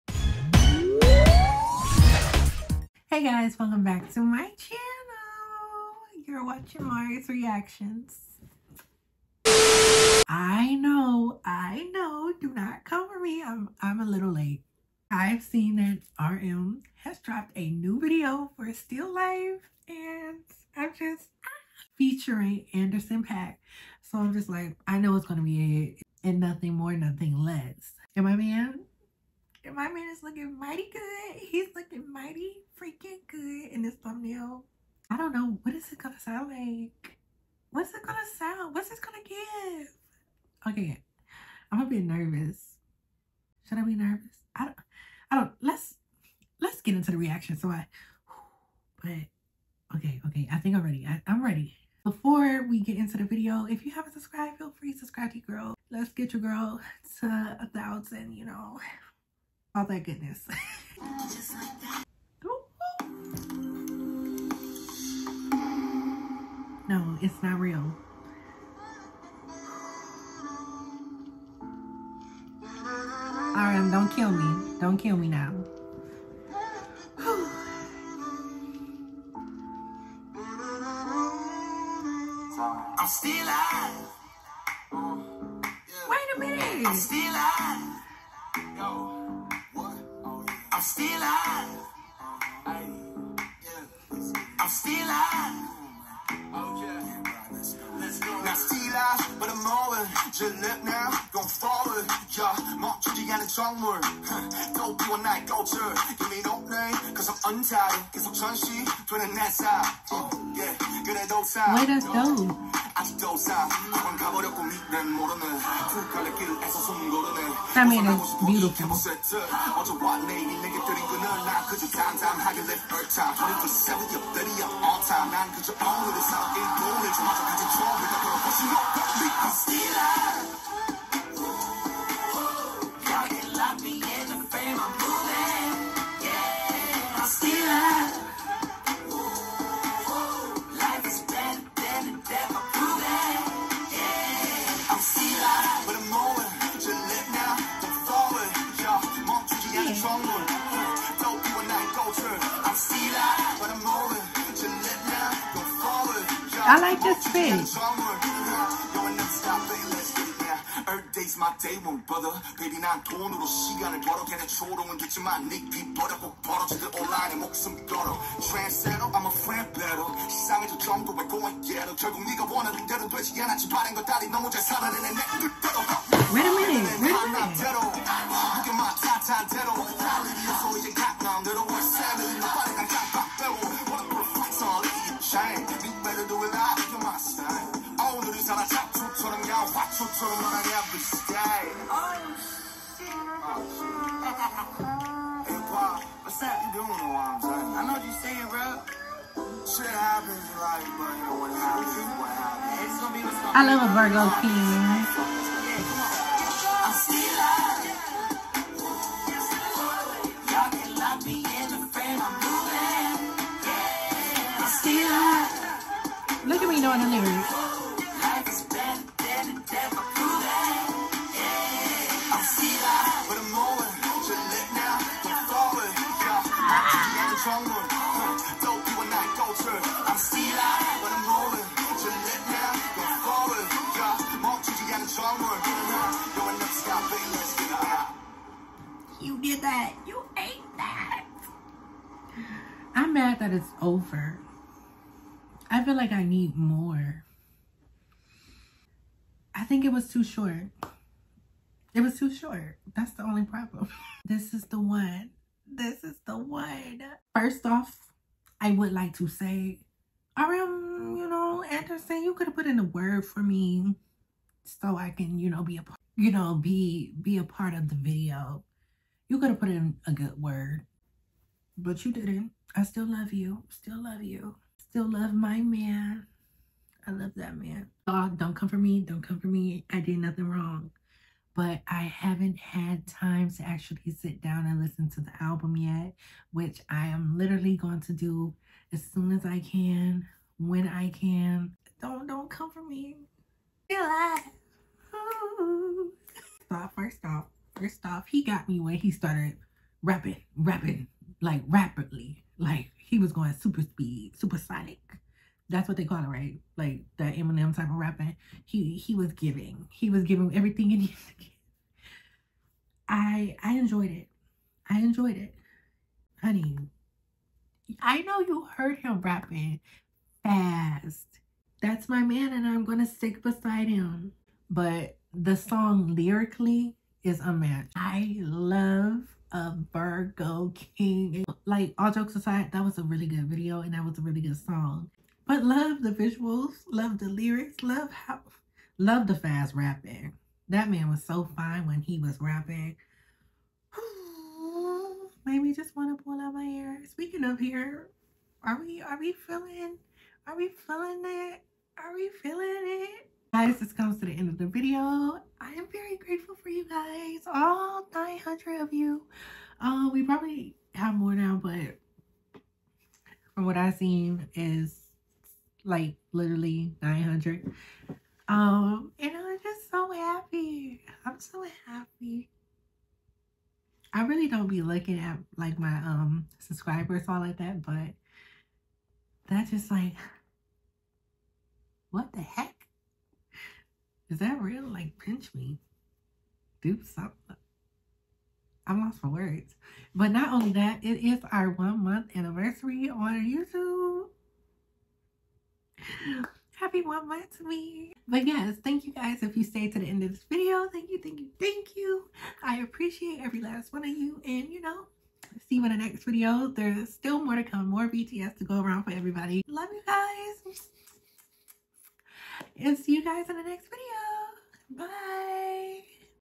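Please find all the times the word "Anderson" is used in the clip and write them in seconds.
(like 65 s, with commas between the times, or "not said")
22 s, 261 s.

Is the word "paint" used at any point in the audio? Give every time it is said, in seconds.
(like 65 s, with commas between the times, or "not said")
not said.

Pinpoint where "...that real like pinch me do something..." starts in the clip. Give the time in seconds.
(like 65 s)
384 s.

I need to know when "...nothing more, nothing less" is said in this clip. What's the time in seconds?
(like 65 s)
26 s.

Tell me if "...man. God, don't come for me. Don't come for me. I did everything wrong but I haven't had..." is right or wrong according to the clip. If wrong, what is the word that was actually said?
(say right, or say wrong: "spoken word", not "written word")
wrong: "nothing", not "everything".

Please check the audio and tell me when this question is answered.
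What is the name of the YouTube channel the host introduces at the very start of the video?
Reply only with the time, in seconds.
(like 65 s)
6 s.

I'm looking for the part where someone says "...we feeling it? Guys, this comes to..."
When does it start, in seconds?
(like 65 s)
352 s.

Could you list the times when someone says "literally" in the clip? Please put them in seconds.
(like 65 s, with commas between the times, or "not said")
287 s, 366 s.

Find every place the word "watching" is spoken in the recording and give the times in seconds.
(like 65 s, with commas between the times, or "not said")
6 s.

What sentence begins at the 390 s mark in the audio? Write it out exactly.
But not only that, it is our one month anniversary on YouTube happy one month to me.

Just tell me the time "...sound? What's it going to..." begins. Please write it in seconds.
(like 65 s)
38 s.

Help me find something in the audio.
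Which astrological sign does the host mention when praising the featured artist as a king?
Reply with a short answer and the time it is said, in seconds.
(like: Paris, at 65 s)
Virgo, at 329 s.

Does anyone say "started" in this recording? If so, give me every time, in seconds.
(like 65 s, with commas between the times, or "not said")
299 s.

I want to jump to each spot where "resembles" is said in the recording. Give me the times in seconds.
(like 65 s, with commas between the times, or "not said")
not said.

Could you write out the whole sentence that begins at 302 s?
Like he was going super speed, supersonic.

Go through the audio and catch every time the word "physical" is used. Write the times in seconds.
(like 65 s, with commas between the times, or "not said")
not said.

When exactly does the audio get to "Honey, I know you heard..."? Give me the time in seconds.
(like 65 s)
316 s.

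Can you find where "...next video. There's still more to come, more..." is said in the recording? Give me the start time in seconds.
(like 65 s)
405 s.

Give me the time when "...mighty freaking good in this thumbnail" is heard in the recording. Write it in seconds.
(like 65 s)
32 s.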